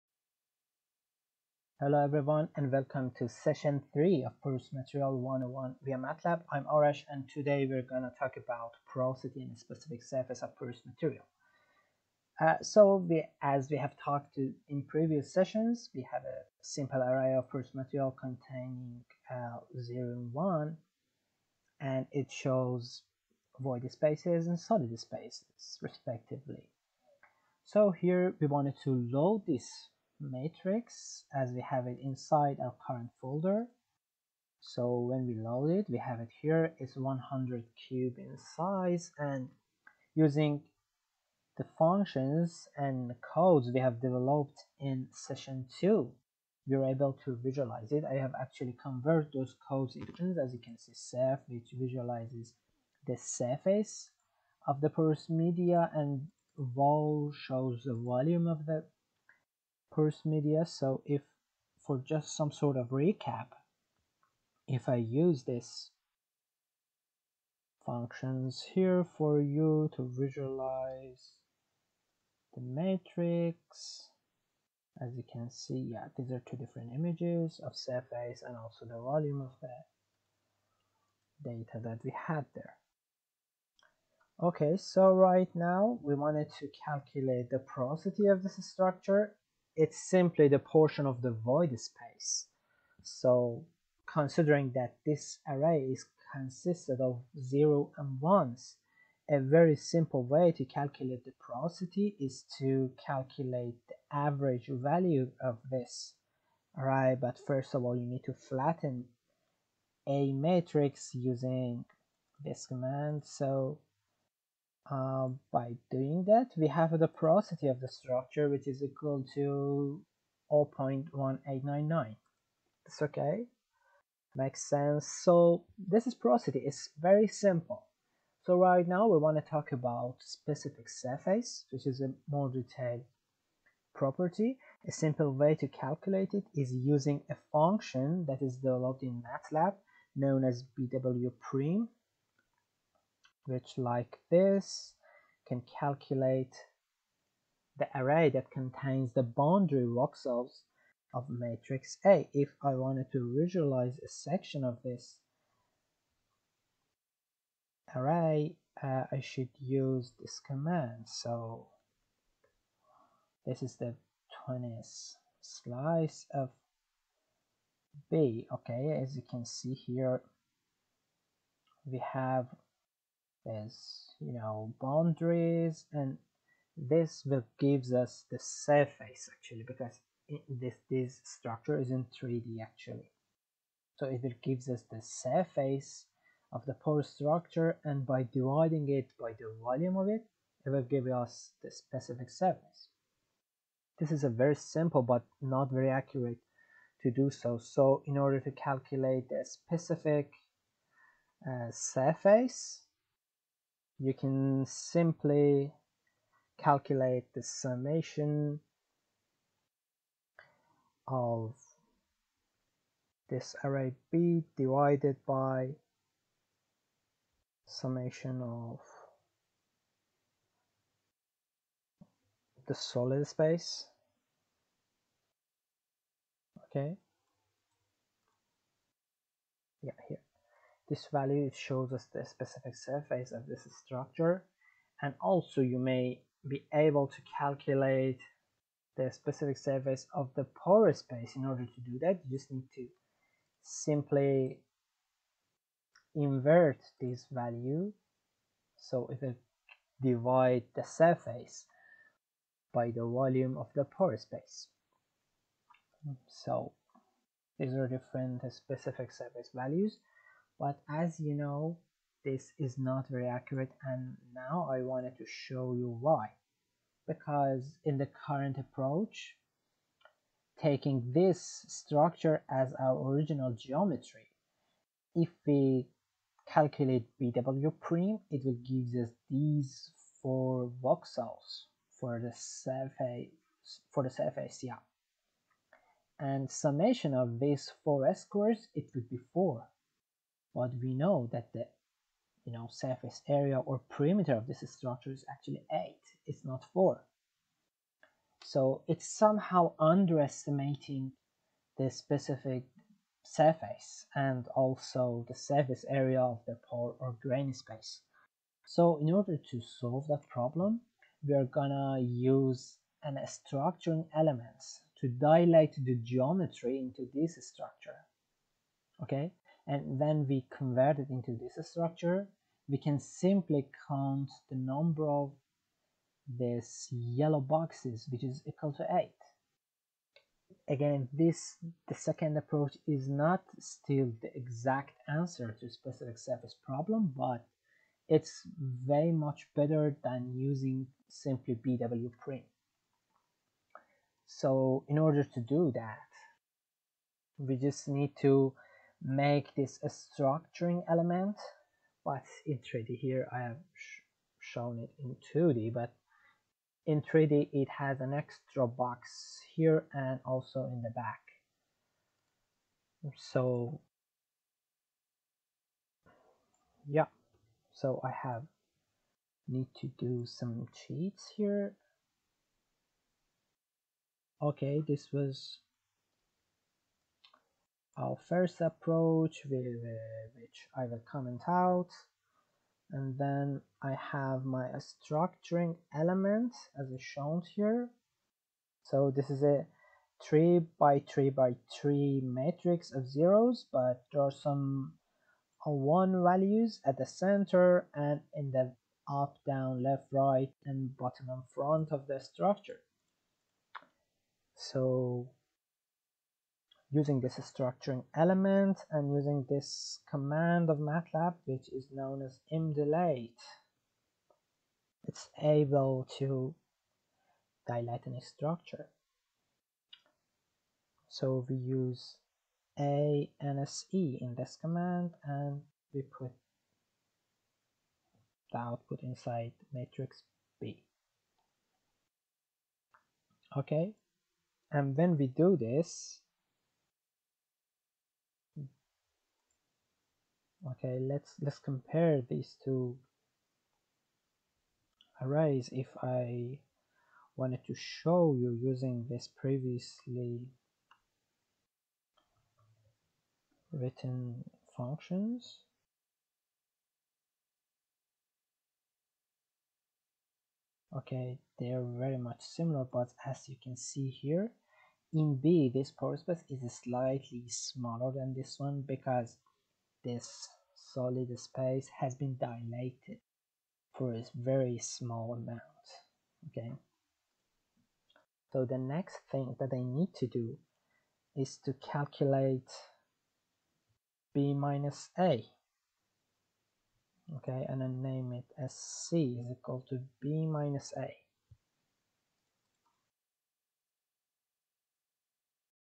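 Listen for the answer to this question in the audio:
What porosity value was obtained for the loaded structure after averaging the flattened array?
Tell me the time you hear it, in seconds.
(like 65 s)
120 s.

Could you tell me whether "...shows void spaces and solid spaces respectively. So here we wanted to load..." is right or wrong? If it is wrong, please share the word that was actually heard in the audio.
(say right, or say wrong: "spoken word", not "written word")
right.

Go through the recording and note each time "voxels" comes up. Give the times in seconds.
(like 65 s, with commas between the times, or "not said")
149 s, 280 s.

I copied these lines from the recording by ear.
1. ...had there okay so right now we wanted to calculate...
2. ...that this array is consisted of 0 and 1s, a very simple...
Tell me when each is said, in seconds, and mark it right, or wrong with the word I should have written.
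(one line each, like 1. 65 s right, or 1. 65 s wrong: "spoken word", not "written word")
1. 82 s right
2. 94 s right.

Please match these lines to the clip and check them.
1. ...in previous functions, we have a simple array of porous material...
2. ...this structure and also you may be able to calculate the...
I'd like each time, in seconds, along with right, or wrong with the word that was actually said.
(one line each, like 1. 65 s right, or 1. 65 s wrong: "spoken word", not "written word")
1. 14 s wrong: "sessions", not "functions"
2. 233 s right.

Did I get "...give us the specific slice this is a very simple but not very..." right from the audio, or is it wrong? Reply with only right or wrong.
wrong.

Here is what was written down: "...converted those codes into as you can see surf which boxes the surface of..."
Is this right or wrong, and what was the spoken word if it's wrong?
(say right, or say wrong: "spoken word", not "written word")
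wrong: "visualizes", not "boxes".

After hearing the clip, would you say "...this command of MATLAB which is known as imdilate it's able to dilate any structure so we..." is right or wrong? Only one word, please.
right.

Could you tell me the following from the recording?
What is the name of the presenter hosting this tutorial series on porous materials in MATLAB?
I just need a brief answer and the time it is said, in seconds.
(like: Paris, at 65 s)
Arash, at 6 s.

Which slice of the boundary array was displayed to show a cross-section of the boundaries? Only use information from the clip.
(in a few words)
20th.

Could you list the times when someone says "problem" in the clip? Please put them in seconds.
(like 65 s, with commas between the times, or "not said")
310 s, 336 s.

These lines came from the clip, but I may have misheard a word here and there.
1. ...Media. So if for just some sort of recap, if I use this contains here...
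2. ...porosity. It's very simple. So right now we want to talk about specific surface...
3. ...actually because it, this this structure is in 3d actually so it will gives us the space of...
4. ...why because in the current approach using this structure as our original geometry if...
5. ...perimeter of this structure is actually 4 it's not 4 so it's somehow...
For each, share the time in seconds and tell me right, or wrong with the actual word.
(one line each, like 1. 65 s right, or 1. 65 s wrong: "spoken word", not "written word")
1. 60 s wrong: "functions", not "contains"
2. 126 s right
3. 179 s wrong: "surface", not "space"
4. 265 s wrong: "taking", not "using"
5. 293 s wrong: "8", not "4".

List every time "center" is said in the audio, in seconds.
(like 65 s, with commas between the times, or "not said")
397 s.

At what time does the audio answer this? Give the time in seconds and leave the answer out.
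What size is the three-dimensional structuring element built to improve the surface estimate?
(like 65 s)
390 s.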